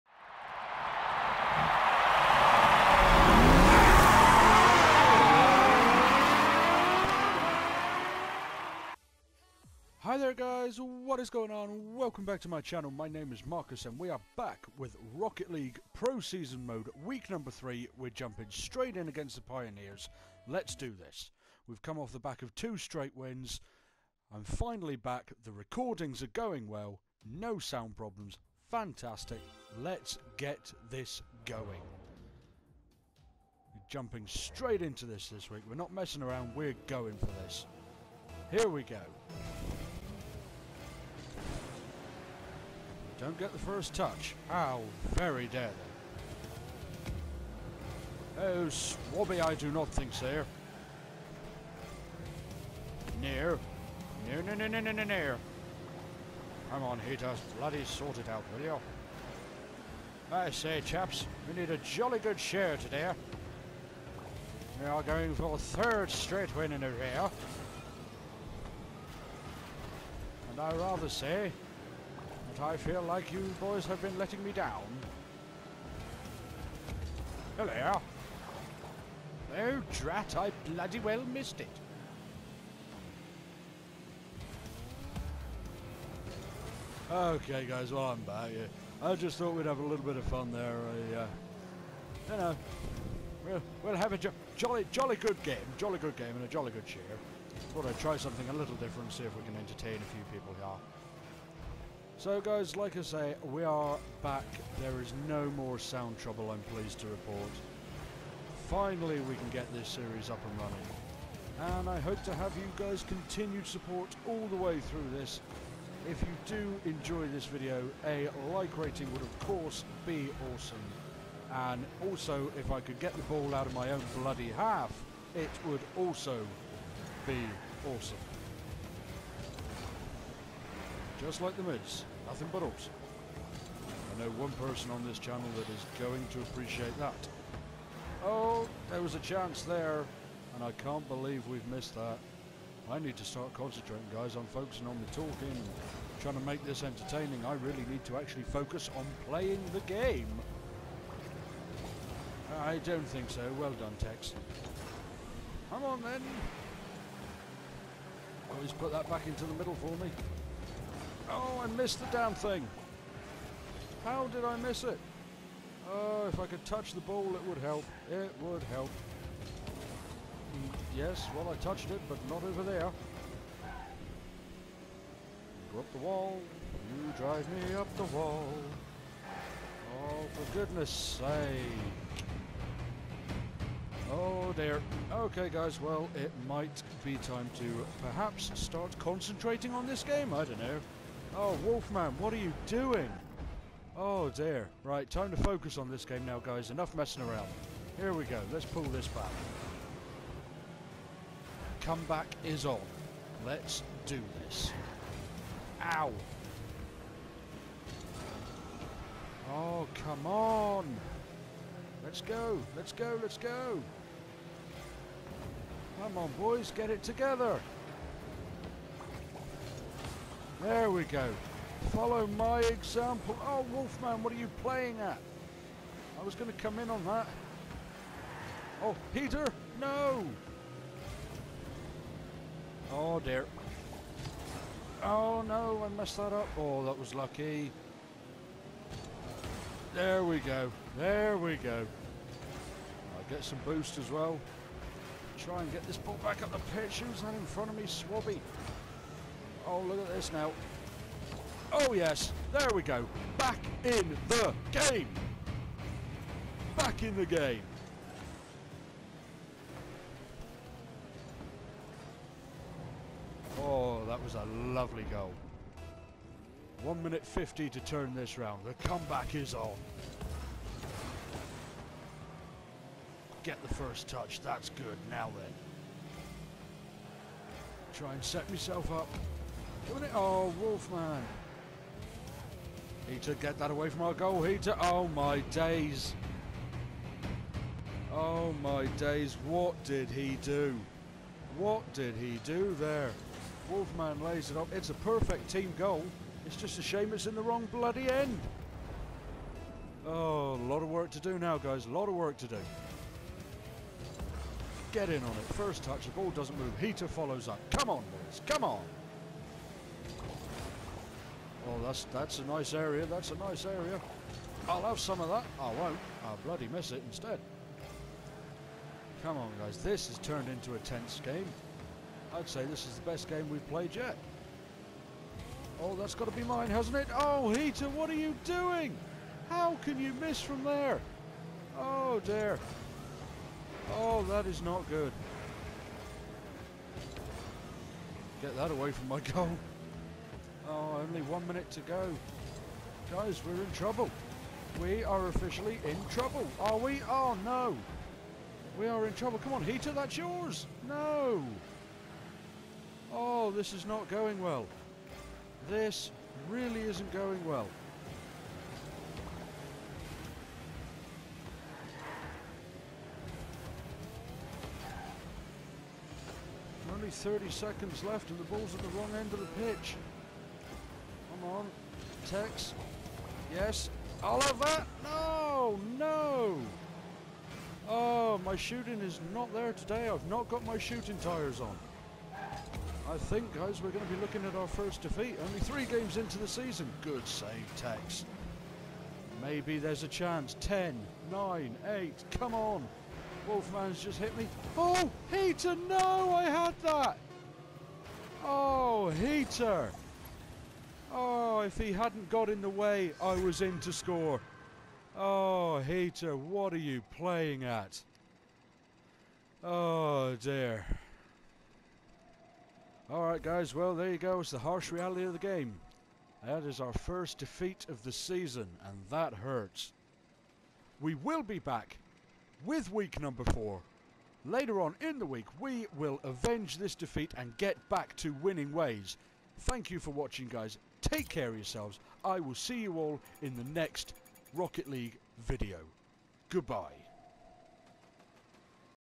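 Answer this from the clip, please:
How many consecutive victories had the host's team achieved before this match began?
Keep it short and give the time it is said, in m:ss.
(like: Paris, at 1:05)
2, at 0:22.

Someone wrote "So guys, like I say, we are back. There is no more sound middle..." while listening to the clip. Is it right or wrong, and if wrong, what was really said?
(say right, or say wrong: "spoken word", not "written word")
wrong: "trouble", not "middle".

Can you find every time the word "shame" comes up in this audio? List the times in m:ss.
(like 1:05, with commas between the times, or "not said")
4:56.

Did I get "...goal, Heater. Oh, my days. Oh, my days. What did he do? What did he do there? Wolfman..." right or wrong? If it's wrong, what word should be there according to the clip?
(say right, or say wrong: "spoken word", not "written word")
right.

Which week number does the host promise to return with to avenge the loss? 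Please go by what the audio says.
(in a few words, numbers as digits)
4.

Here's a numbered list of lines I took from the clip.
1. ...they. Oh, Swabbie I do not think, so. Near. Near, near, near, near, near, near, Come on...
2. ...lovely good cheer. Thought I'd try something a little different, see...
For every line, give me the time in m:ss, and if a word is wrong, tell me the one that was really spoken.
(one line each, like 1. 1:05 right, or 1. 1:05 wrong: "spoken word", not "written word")
1. 0:48 right
2. 1:36 wrong: "jolly", not "lovely".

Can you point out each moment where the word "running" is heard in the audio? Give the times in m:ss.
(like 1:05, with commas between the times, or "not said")
1:50.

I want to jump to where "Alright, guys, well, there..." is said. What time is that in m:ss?
6:53.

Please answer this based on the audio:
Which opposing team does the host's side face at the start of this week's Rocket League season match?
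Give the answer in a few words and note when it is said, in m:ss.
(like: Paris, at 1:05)
Pioneers, at 0:19.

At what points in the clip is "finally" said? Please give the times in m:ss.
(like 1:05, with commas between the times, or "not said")
0:24, 1:48.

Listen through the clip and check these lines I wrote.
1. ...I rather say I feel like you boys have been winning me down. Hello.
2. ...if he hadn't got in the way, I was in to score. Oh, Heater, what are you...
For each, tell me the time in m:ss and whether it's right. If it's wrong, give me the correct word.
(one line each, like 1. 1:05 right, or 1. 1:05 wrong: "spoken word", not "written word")
1. 1:10 wrong: "letting", not "winning"
2. 6:41 right.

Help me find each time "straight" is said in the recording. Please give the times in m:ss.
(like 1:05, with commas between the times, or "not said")
0:18, 0:22, 0:34, 1:06.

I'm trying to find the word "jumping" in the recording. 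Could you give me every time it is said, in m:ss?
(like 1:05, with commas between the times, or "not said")
0:18, 0:33.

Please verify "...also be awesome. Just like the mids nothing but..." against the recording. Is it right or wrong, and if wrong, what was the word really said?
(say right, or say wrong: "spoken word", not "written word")
right.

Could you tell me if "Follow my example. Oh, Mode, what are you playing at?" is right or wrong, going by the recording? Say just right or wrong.
wrong.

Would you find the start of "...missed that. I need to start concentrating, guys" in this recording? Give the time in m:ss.
2:21.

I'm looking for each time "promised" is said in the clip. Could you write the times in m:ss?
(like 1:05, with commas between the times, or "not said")
not said.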